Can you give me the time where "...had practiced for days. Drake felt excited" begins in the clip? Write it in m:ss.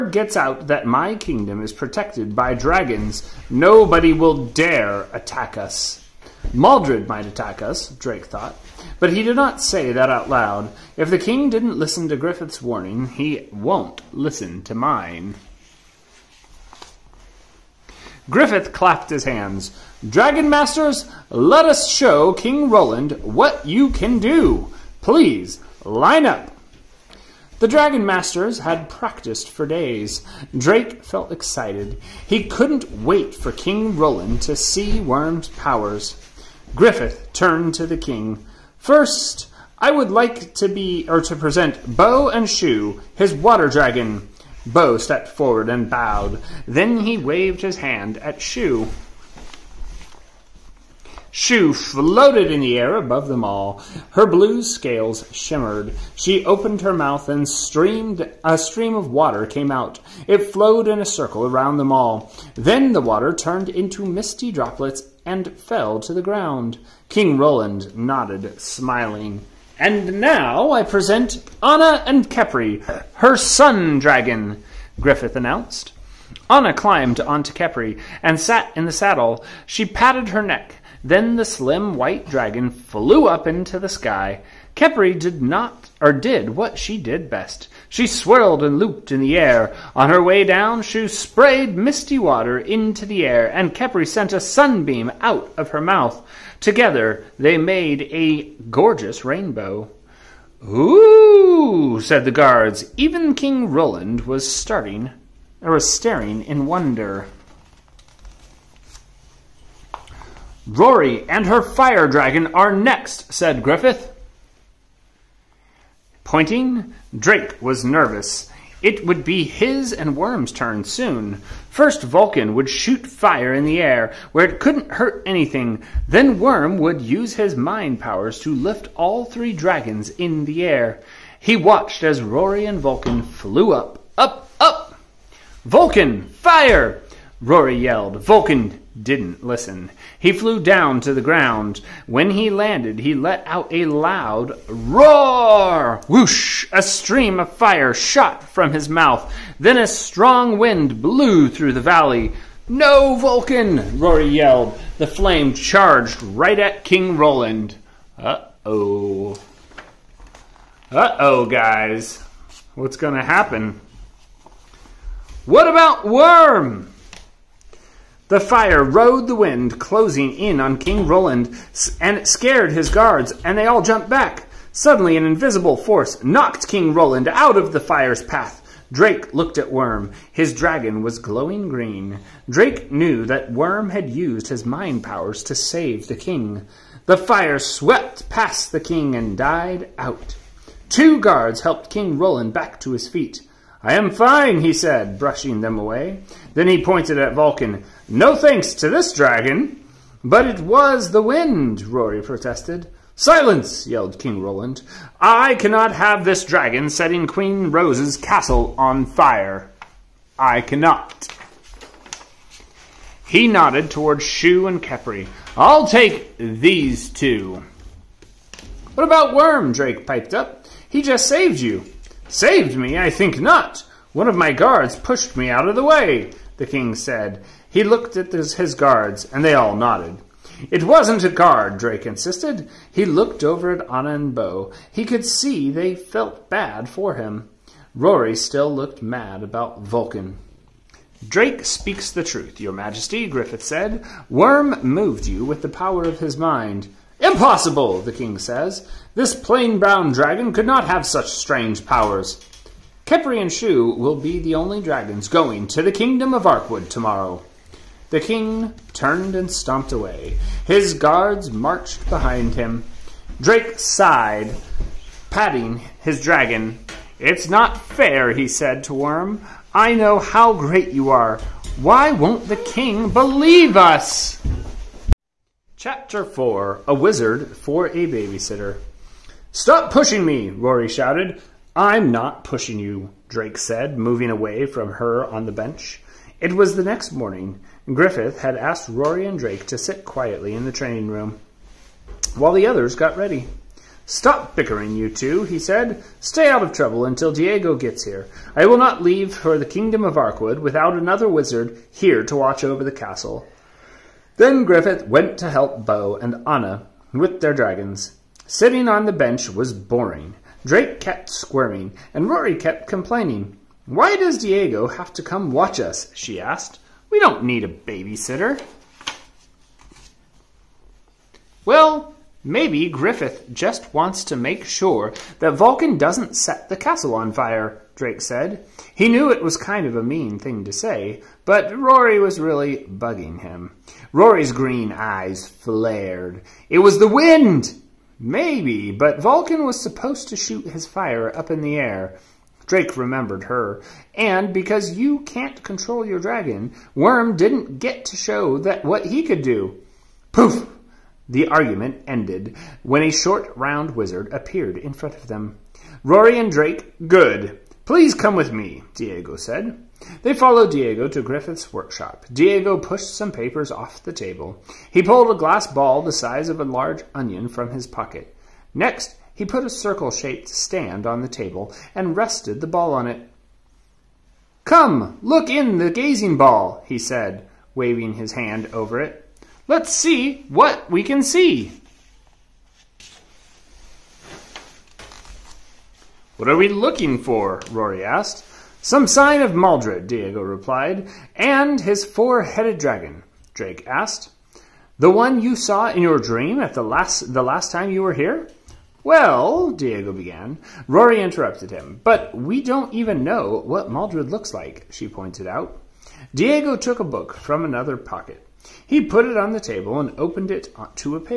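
0:28.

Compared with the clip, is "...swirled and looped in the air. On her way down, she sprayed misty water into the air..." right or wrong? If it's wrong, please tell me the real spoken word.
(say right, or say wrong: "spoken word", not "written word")
right.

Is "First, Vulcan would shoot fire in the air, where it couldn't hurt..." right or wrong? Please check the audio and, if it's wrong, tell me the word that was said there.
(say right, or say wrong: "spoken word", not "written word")
right.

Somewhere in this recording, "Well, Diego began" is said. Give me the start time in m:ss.
6:39.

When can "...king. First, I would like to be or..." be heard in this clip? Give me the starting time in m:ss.
0:37.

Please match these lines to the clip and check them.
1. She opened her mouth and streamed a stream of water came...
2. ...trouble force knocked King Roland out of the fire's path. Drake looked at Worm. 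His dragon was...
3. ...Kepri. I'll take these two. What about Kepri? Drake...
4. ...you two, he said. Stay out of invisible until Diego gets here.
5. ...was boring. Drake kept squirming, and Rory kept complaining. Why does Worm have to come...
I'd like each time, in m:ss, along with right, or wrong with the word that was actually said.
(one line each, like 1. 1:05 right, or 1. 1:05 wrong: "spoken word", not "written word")
1. 0:56 right
2. 2:55 wrong: "invisible", not "trouble"
3. 3:34 wrong: "Worm", not "Kepri"
4. 4:54 wrong: "trouble", not "invisible"
5. 5:09 wrong: "Diego", not "Worm".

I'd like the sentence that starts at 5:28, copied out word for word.
He knew it was kind of a mean thing to say, but Rory was really bugging him.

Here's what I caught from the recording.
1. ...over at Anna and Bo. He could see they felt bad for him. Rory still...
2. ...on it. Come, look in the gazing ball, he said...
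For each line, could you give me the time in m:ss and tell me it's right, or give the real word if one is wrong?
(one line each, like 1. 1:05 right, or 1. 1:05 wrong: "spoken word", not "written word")
1. 3:53 right
2. 6:12 right.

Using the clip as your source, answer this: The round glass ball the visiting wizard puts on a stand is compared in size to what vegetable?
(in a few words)
a large onion.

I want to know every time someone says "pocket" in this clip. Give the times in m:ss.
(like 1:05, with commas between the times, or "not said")
6:07, 6:47.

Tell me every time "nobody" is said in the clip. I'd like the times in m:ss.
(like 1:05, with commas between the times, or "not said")
0:03.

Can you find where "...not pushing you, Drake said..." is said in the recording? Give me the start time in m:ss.
4:42.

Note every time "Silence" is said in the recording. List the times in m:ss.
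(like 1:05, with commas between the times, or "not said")
3:23.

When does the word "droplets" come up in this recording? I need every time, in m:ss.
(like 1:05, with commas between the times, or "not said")
1:04.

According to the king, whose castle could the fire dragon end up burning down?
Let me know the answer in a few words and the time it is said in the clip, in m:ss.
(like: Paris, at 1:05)
Queen Rose's, at 3:27.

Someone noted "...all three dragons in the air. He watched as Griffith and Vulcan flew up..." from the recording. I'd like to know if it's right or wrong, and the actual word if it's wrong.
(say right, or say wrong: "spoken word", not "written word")
wrong: "Rory", not "Griffith".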